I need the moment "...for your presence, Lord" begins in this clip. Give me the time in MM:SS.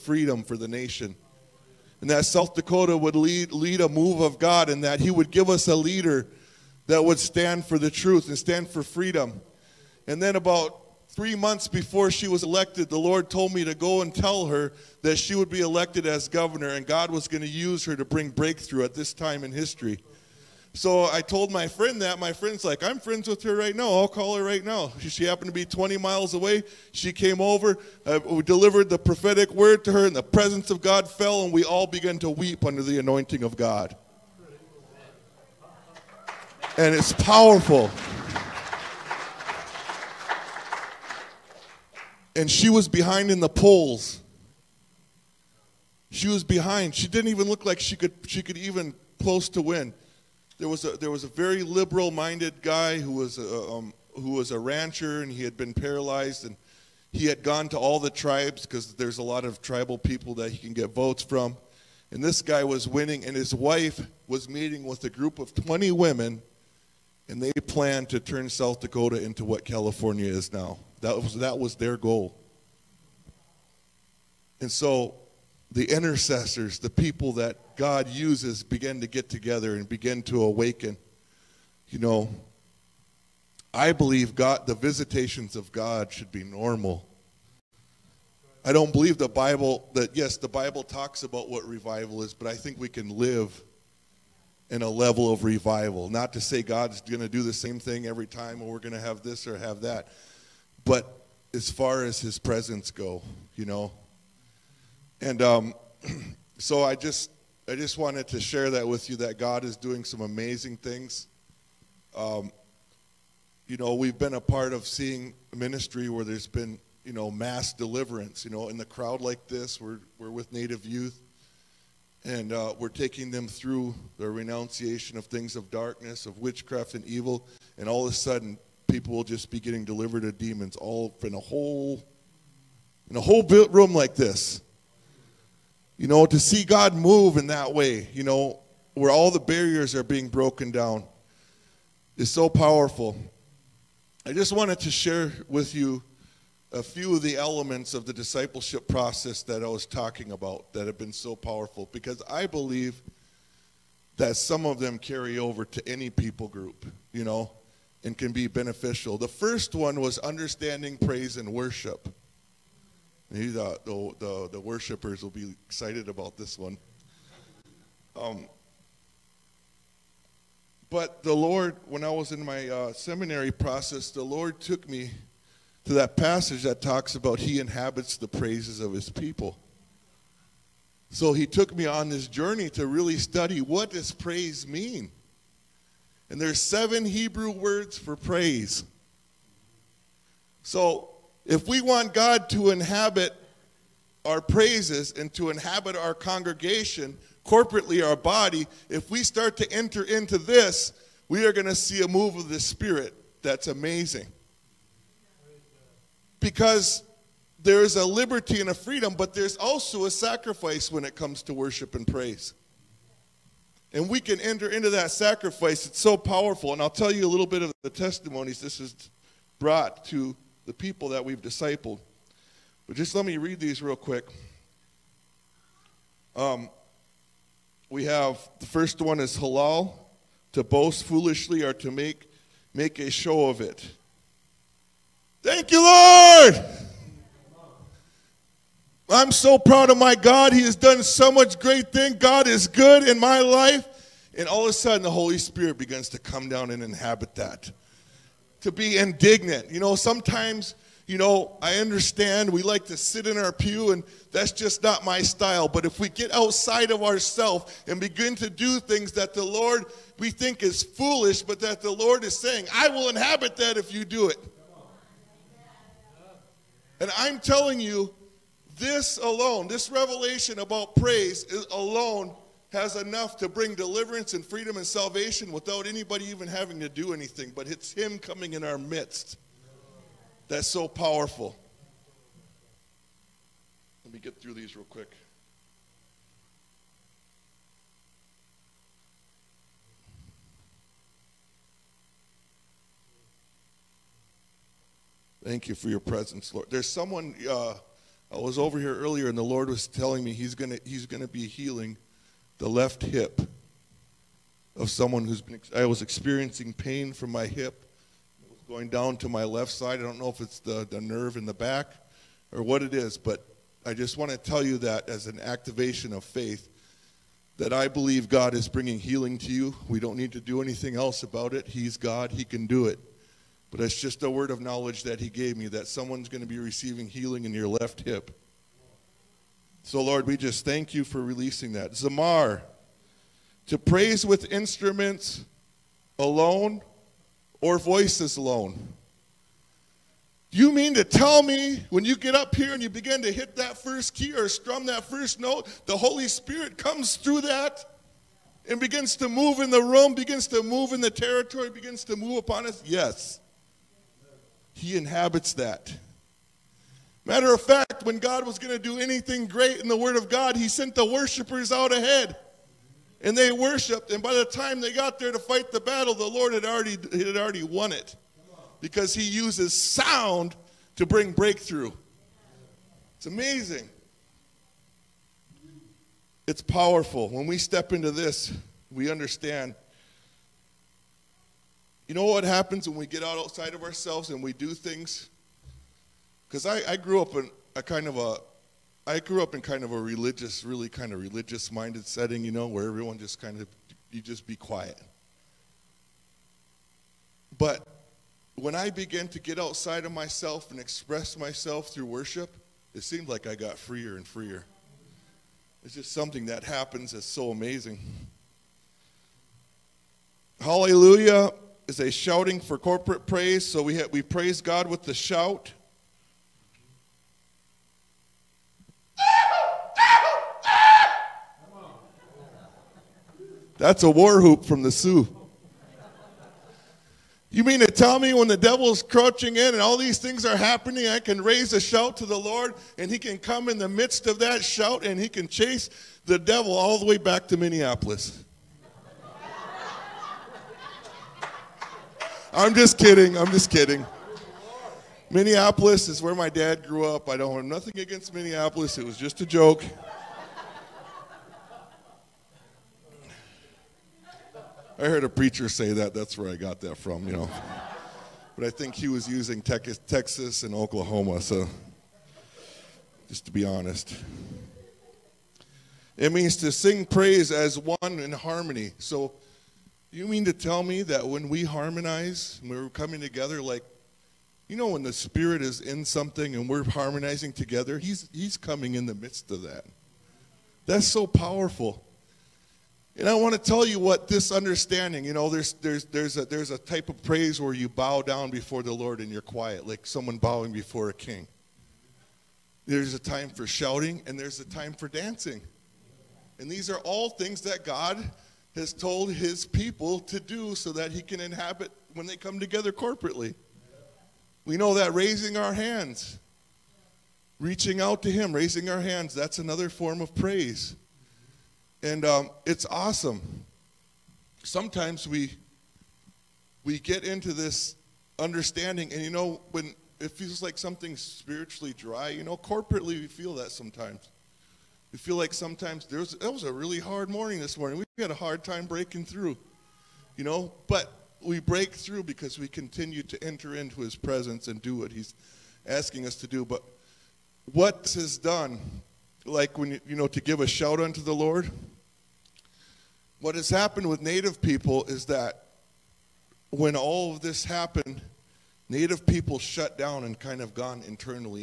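04:55.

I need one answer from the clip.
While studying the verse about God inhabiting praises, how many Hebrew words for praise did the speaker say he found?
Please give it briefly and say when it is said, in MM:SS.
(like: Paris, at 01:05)
7, at 03:06.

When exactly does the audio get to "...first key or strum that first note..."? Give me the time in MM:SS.
05:43.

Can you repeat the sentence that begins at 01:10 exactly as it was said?
That was, that was their goal.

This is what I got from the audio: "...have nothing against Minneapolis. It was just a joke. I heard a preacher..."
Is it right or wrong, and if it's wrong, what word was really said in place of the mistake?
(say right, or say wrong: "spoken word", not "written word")
right.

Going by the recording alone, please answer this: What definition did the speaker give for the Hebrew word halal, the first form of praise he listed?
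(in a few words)
To boast foolishly.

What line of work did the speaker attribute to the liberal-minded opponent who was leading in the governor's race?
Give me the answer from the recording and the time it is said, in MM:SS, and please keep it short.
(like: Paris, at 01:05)
Rancher, at 00:54.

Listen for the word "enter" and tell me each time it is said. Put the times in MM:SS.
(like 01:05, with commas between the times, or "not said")
03:19, 03:34, 08:53.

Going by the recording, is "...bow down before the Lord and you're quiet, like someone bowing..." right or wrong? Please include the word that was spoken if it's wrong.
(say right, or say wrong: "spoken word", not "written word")
right.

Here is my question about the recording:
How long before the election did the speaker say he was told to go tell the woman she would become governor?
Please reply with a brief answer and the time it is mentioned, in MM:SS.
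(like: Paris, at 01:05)
3 months, at 00:11.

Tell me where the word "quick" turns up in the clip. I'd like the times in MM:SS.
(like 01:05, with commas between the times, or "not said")
03:43, 04:44.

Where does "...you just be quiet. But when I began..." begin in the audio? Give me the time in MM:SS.
06:34.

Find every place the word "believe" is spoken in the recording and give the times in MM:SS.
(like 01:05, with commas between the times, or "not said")
01:23, 01:28, 02:32, 05:17.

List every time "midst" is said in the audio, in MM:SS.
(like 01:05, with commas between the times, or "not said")
04:38, 07:13, 07:59.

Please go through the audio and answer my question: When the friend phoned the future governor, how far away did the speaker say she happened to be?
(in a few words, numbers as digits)
20 miles.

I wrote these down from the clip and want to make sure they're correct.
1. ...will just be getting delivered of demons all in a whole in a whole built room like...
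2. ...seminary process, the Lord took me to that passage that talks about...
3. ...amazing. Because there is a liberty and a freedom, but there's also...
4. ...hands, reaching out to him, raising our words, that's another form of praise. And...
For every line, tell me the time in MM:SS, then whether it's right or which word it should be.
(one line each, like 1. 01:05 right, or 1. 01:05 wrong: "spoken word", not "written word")
1. 02:09 right
2. 02:52 right
3. 03:23 right
4. 08:25 wrong: "hands", not "words".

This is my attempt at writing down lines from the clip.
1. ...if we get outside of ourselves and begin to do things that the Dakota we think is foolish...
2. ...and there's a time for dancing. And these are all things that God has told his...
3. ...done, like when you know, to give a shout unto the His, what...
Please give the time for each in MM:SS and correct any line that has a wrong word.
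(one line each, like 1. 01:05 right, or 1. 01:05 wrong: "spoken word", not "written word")
1. 04:15 wrong: "Lord", not "Dakota"
2. 08:14 right
3. 08:58 wrong: "Lord", not "His".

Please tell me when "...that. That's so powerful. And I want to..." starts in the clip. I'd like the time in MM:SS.
07:59.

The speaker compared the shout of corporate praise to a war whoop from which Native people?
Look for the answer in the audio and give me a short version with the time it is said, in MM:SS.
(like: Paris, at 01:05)
Sioux, at 07:04.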